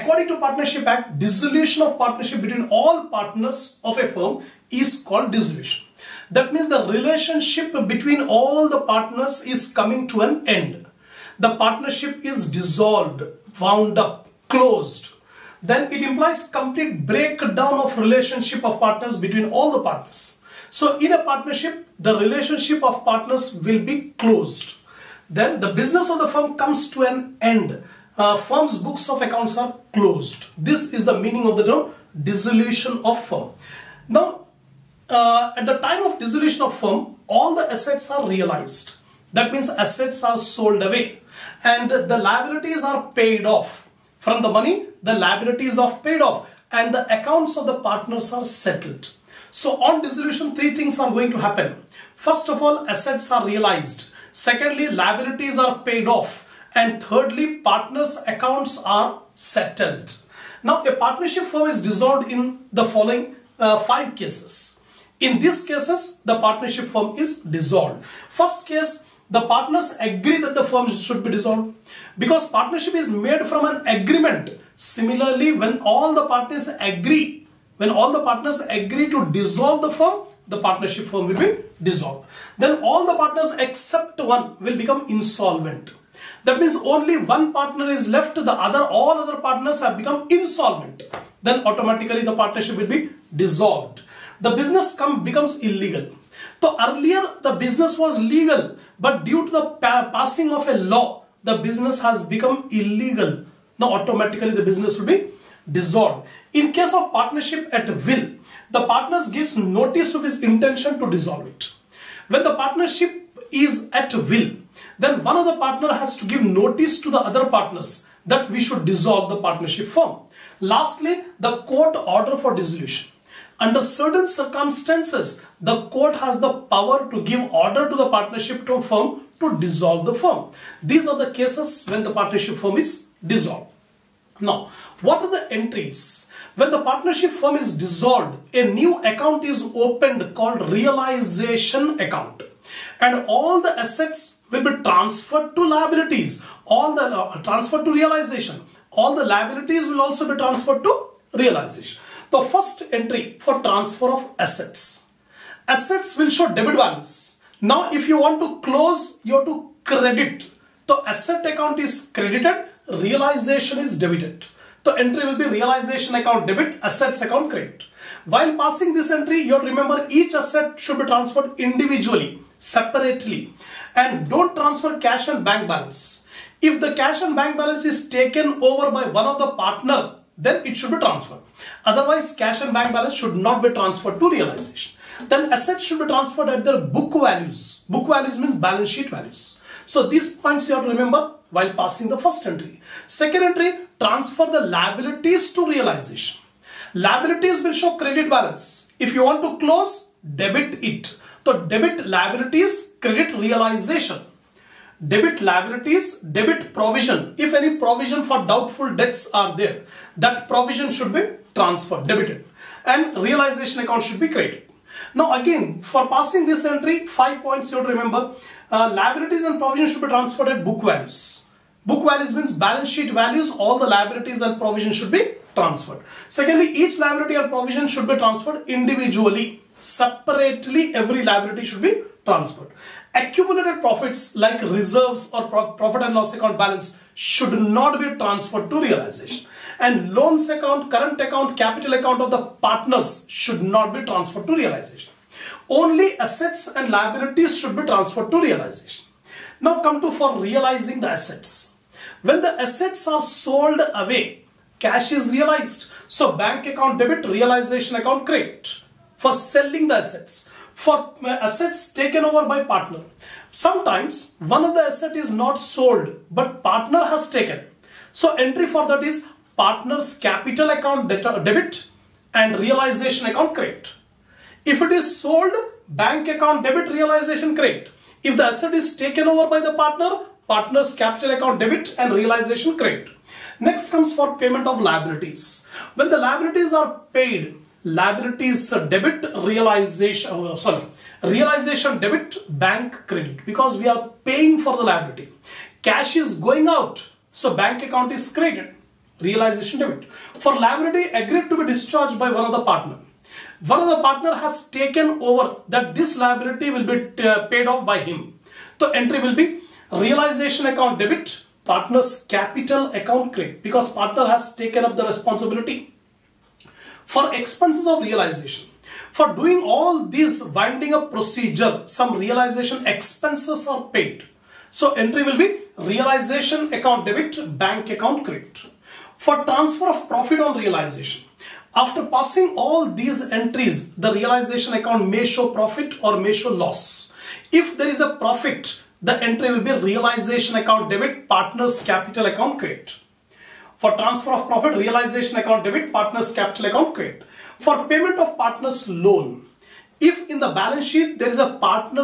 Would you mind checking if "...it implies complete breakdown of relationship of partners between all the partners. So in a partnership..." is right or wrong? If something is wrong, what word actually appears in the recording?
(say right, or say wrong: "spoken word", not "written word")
right.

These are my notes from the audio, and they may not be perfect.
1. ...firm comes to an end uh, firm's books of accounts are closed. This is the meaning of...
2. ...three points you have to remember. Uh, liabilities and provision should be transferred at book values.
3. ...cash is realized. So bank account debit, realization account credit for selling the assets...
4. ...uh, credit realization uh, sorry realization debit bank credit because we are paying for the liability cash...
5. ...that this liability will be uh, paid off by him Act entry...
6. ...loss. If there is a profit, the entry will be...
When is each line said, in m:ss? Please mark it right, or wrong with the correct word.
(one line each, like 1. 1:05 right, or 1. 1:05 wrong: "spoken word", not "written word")
1. 0:26 right
2. 3:37 wrong: "five", not "three"
3. 4:14 right
4. 4:48 wrong: "debit", not "credit"
5. 5:05 wrong: "The", not "Act"
6. 5:36 right.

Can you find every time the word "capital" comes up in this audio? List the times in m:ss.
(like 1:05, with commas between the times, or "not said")
4:01, 4:30, 4:40, 5:12, 5:41, 5:46.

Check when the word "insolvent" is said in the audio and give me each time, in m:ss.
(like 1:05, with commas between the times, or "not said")
1:25, 1:30.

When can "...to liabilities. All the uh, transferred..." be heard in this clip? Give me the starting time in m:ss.
2:25.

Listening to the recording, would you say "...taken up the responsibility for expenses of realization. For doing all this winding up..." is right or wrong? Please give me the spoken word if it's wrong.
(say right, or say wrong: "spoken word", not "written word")
right.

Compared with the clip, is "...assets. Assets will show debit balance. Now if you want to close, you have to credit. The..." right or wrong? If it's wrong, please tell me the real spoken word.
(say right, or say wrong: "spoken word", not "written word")
right.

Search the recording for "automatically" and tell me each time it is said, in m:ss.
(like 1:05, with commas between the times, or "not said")
1:31, 1:43.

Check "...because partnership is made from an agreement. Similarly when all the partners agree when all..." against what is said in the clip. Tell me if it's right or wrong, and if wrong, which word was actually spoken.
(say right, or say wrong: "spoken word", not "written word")
right.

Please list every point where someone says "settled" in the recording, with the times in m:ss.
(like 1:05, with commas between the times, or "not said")
0:48, 0:59.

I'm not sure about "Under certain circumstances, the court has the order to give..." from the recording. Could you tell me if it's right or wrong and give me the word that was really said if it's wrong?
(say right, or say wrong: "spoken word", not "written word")
wrong: "power", not "order".